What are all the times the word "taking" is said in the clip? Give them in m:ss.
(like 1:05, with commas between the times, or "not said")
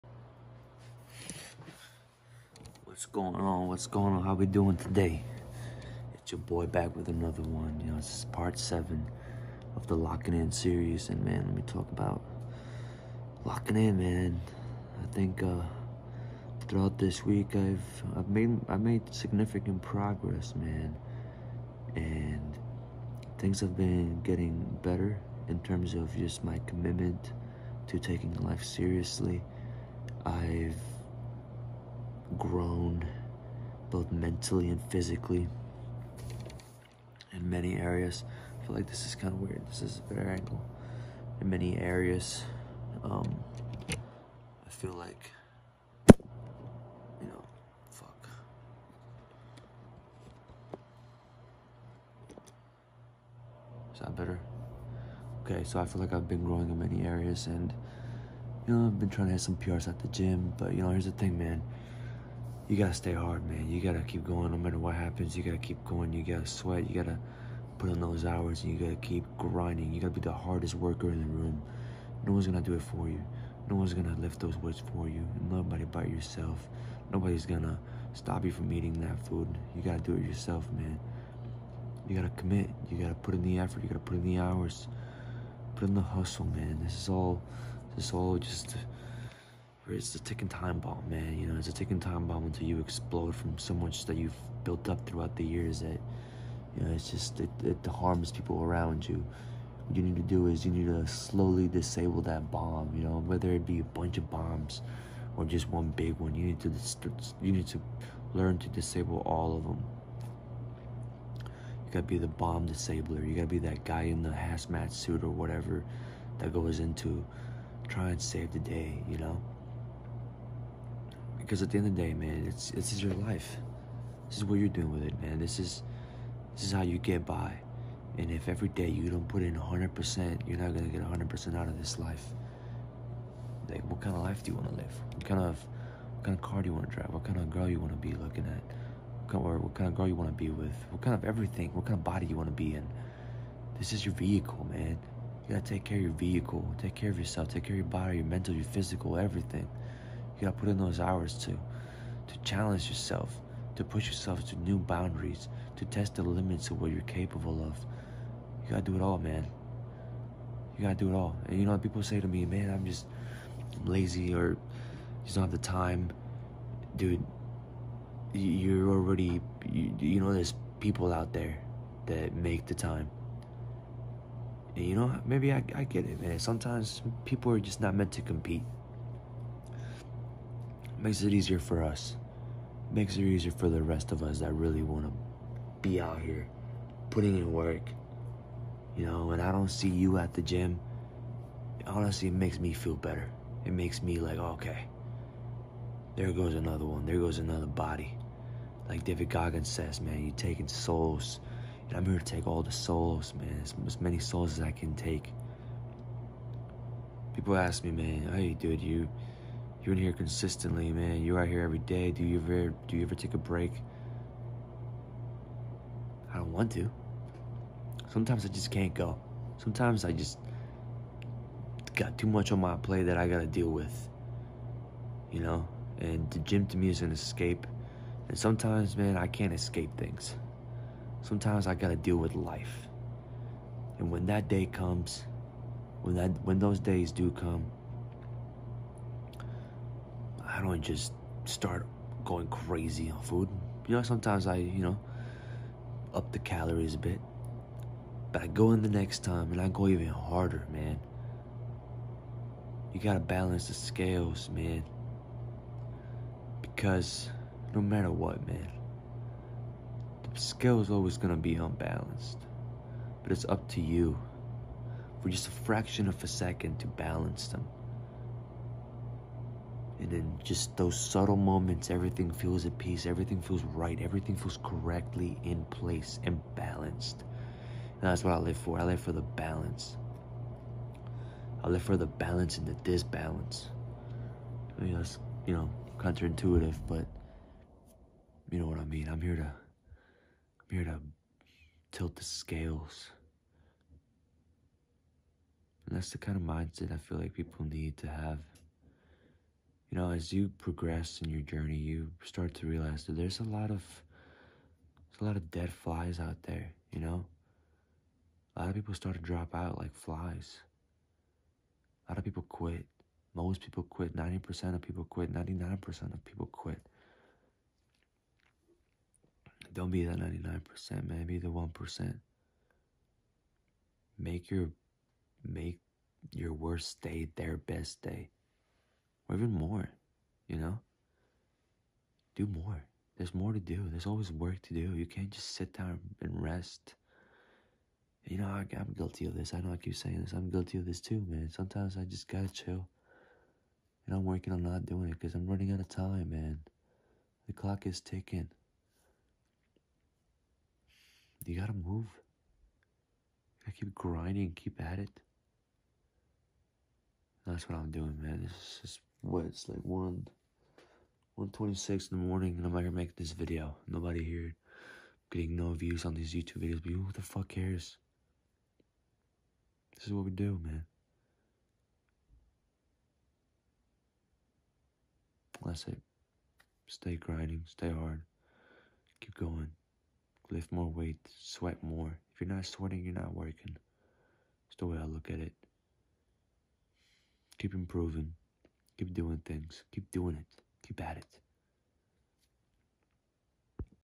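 0:27, 3:20.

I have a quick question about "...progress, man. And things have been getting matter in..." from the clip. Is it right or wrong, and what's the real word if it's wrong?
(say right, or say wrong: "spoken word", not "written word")
wrong: "better", not "matter".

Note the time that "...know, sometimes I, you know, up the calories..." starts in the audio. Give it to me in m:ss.
4:03.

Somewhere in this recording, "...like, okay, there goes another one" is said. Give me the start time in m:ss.
3:14.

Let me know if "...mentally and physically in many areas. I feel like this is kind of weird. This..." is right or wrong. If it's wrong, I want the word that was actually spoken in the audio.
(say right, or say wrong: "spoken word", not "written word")
right.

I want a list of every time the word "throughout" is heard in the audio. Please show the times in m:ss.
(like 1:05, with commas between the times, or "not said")
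0:16, 1:35.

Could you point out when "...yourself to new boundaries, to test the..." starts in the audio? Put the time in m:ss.
2:34.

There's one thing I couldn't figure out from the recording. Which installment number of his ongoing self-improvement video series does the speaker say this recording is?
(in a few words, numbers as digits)
7.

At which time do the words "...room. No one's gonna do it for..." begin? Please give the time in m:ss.
1:11.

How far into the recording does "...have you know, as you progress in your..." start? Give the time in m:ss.
4:58.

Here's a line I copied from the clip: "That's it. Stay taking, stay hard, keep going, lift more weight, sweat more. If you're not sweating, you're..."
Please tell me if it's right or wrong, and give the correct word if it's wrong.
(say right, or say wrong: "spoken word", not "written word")
wrong: "grinding", not "taking".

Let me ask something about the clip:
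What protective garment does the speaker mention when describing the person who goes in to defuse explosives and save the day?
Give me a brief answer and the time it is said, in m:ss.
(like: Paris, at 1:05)
hazmat suit, at 1:54.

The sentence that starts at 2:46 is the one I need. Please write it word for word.
Dude, you're already, you, you know, there's people out there that make the time.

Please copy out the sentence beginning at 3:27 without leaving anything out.
People ask me, man, hey, dude, you you're in here consistently, man.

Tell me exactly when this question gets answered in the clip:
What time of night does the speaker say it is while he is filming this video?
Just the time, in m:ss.
6:01.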